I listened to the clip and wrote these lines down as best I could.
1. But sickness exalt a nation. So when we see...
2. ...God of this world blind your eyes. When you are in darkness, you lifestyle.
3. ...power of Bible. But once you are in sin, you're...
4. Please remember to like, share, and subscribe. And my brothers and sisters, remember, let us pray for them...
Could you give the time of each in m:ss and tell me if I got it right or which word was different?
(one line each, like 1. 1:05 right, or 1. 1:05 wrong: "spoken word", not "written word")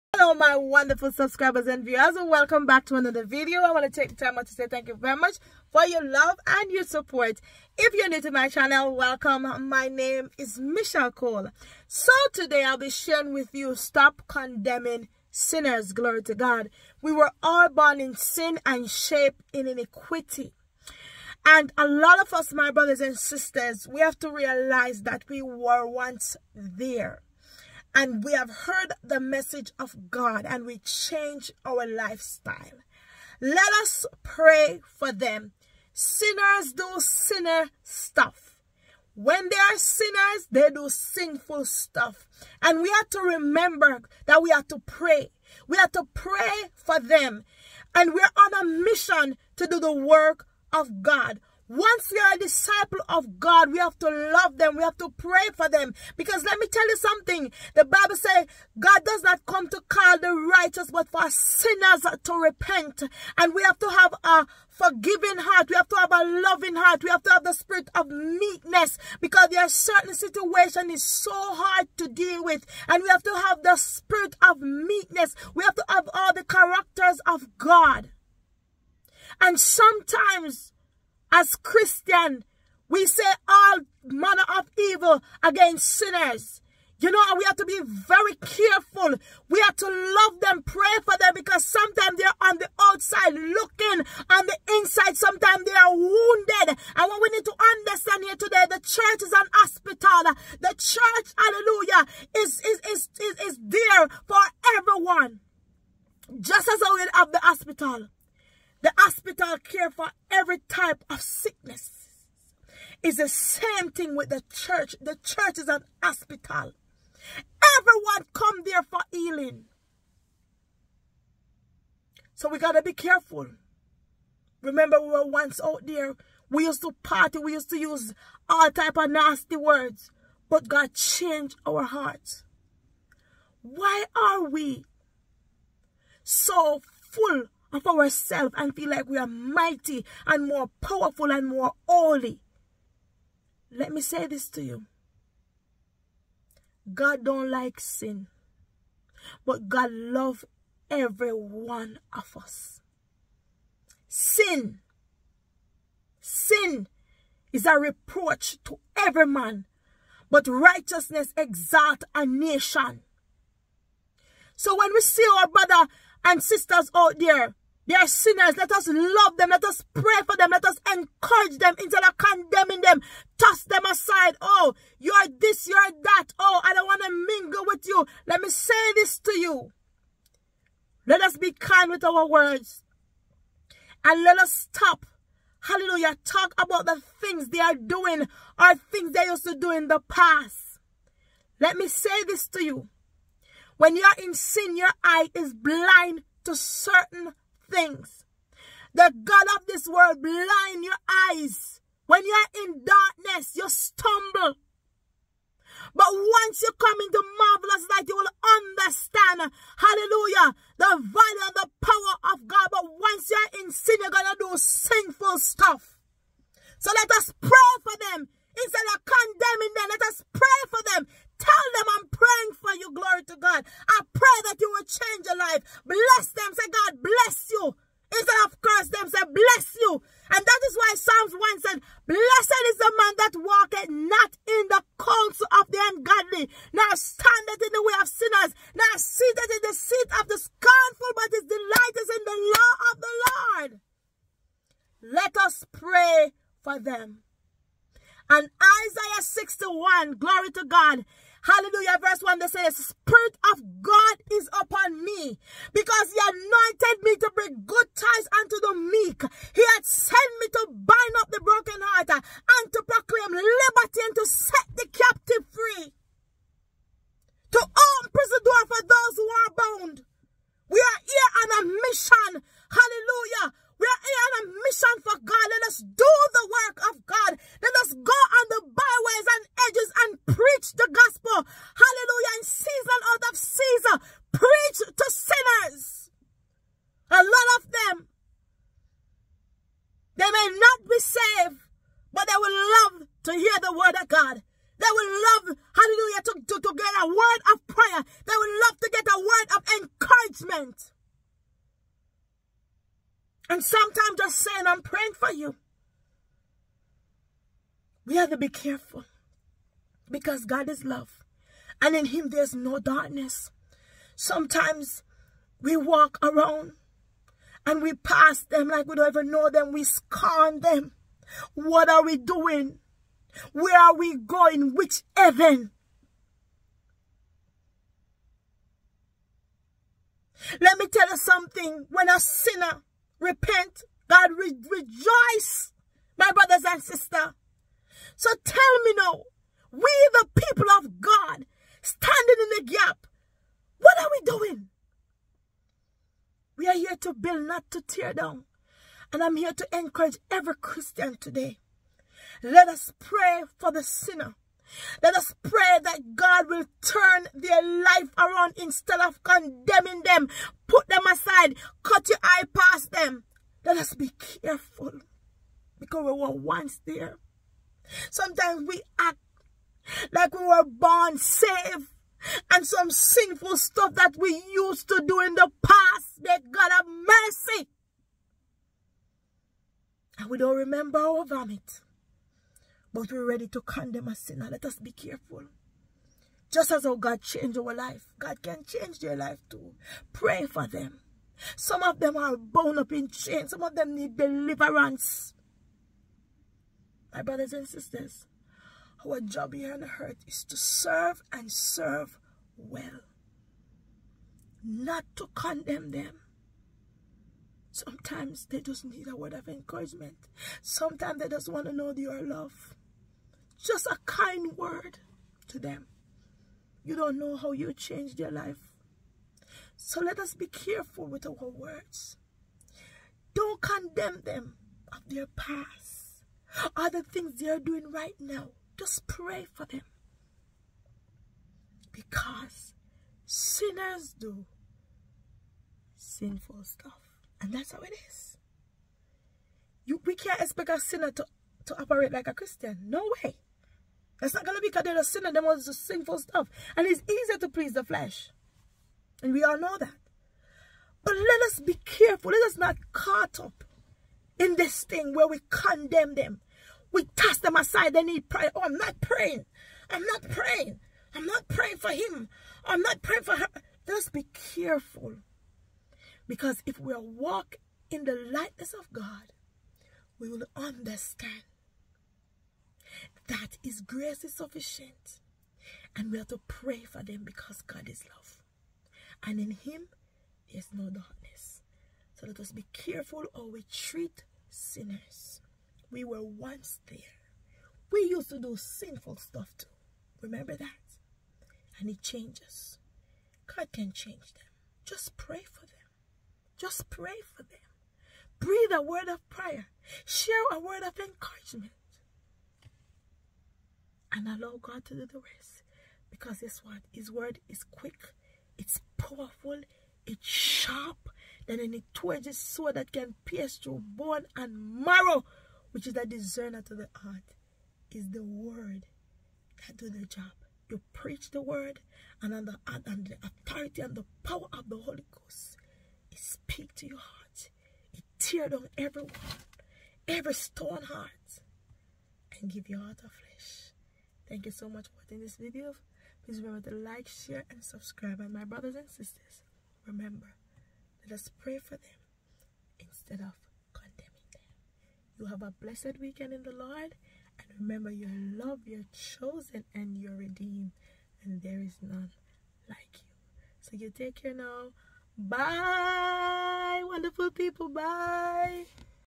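1. 2:40 wrong: "righteousness", not "sickness"
2. 3:19 wrong: "stumble", not "lifestyle"
3. 3:31 wrong: "God", not "Bible"
4. 8:56 right.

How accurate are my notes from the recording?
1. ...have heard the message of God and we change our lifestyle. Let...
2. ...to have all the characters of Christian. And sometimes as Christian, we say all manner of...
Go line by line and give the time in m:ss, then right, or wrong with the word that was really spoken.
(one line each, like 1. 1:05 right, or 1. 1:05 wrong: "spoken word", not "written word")
1. 0:28 right
2. 1:15 wrong: "God", not "Christian".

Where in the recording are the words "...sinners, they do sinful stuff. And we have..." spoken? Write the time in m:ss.
0:39.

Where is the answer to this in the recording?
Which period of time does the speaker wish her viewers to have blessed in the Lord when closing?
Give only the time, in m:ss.
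9:05.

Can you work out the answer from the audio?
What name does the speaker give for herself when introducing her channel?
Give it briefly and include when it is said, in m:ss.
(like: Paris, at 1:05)
Michelle Cole, at 0:10.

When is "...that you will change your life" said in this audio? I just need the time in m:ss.
3:44.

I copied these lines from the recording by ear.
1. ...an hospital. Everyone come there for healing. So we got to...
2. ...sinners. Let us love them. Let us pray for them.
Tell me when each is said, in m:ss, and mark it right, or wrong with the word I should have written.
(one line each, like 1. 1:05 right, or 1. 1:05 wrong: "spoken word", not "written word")
1. 1:55 right
2. 2:48 right.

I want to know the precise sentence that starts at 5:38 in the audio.
So tell me now, we the people of God, standing in the gap, what are we doing?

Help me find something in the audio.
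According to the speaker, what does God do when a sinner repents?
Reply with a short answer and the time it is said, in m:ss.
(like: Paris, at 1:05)
rejoice, at 5:34.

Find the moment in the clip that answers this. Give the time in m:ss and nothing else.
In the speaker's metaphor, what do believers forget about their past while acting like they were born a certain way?
6:20.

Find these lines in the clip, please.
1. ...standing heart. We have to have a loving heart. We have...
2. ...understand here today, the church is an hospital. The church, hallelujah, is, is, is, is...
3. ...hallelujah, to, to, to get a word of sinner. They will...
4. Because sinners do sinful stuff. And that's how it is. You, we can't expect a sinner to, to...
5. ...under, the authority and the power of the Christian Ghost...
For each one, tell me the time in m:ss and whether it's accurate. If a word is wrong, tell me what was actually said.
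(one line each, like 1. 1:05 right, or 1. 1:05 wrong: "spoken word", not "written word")
1. 1:04 wrong: "forgiving", not "standing"
2. 1:37 right
3. 4:55 wrong: "prayer", not "sinner"
4. 7:11 right
5. 8:42 wrong: "Holy", not "Christian".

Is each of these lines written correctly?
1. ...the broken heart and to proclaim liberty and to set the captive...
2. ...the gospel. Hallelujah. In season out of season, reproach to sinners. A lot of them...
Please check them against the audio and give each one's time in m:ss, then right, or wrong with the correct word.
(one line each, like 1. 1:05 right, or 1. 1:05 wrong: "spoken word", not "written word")
1. 4:21 right
2. 4:40 wrong: "preach", not "reproach".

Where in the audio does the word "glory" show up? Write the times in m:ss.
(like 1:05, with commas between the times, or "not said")
0:15, 3:42, 4:10.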